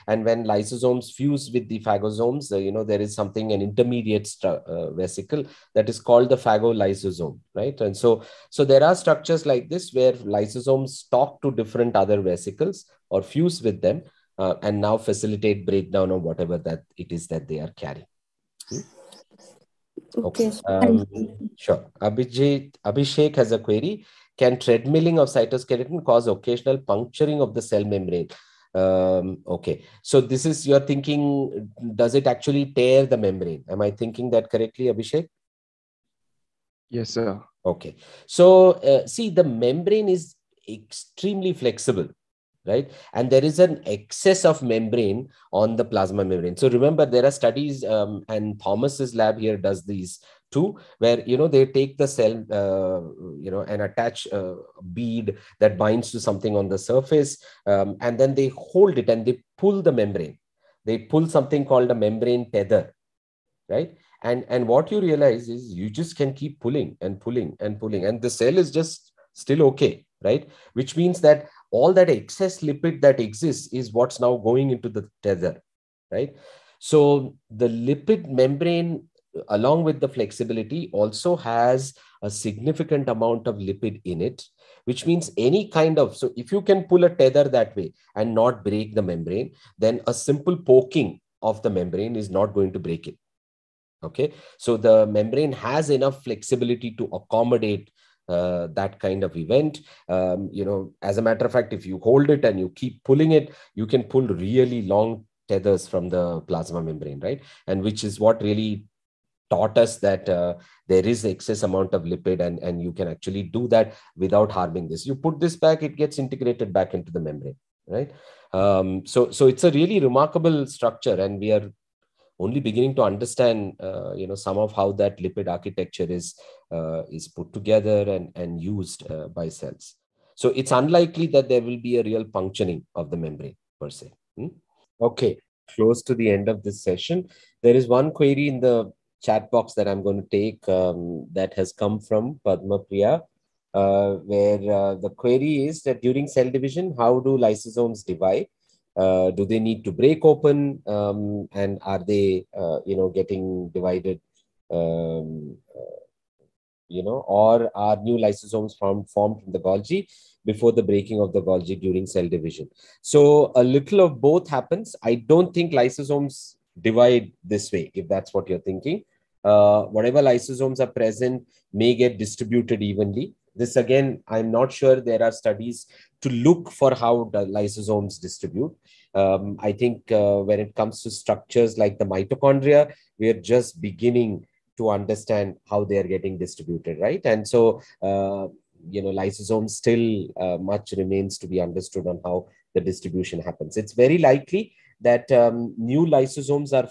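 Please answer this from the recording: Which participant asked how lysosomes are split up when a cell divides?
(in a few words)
Padma Priya.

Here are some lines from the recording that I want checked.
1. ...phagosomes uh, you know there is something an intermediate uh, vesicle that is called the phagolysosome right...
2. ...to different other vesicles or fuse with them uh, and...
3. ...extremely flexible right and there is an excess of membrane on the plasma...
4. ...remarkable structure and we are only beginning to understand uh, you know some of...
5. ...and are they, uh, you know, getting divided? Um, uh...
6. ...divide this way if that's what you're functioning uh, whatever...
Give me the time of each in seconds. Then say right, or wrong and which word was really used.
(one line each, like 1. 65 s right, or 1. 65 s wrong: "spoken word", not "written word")
1. 1 s right
2. 11 s right
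3. 40 s right
4. 120 s right
5. 151 s right
6. 166 s wrong: "thinking", not "functioning".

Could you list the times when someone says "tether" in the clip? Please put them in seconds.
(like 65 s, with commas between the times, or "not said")
62 s, 75 s, 87 s, 105 s.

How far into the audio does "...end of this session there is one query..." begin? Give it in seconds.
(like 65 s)
136 s.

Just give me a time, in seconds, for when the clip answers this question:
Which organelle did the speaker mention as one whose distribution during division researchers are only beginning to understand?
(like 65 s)
182 s.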